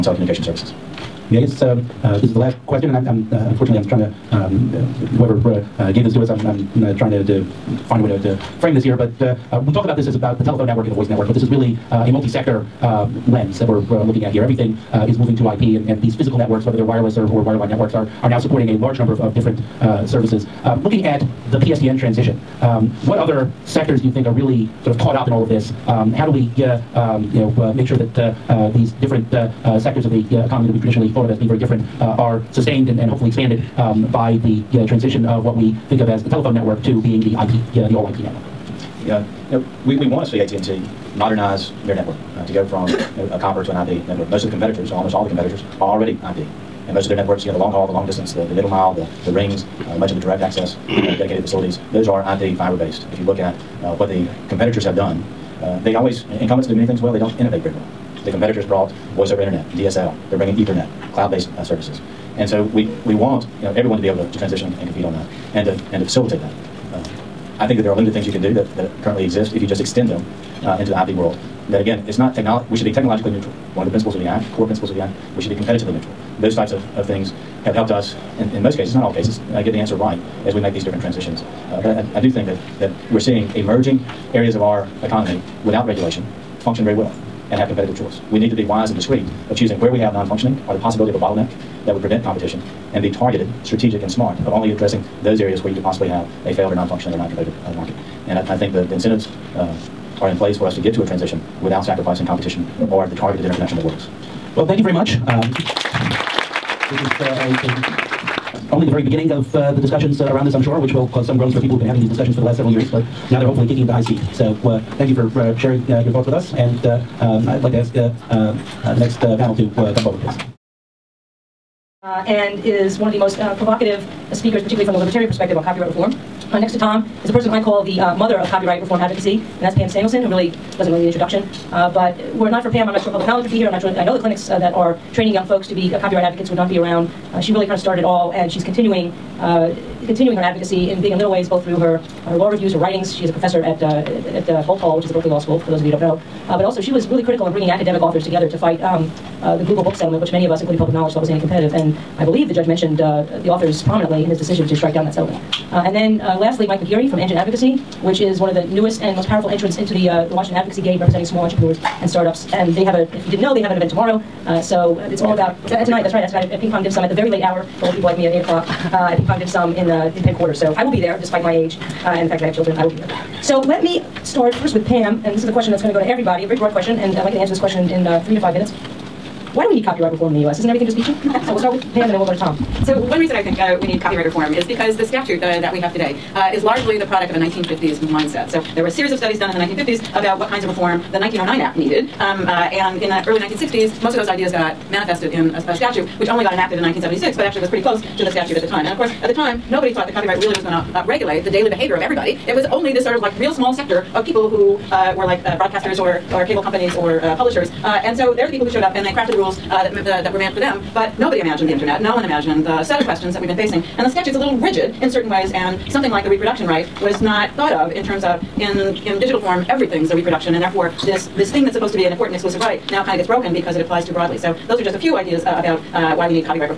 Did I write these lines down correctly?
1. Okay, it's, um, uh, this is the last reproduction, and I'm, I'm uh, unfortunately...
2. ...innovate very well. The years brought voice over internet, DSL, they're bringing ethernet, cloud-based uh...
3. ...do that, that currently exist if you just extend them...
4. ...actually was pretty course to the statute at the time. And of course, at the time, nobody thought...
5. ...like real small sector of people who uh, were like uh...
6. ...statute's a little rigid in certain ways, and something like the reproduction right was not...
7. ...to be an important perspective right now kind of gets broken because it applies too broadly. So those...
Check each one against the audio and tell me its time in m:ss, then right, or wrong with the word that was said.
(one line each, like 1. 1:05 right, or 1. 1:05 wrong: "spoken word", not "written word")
1. 0:01 wrong: "question", not "reproduction"
2. 0:57 wrong: "competitors", not "years"
3. 1:08 right
4. 3:17 wrong: "close", not "course"
5. 3:23 right
6. 3:34 right
7. 3:41 wrong: "exclusive", not "perspective".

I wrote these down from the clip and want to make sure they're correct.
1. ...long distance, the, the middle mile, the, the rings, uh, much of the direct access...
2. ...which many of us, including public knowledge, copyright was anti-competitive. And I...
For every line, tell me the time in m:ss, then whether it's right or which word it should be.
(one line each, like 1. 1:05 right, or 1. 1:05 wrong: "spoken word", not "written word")
1. 0:47 right
2. 2:30 wrong: "thought", not "copyright".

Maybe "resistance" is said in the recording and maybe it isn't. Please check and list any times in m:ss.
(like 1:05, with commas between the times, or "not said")
not said.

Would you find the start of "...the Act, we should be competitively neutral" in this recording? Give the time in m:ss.
1:14.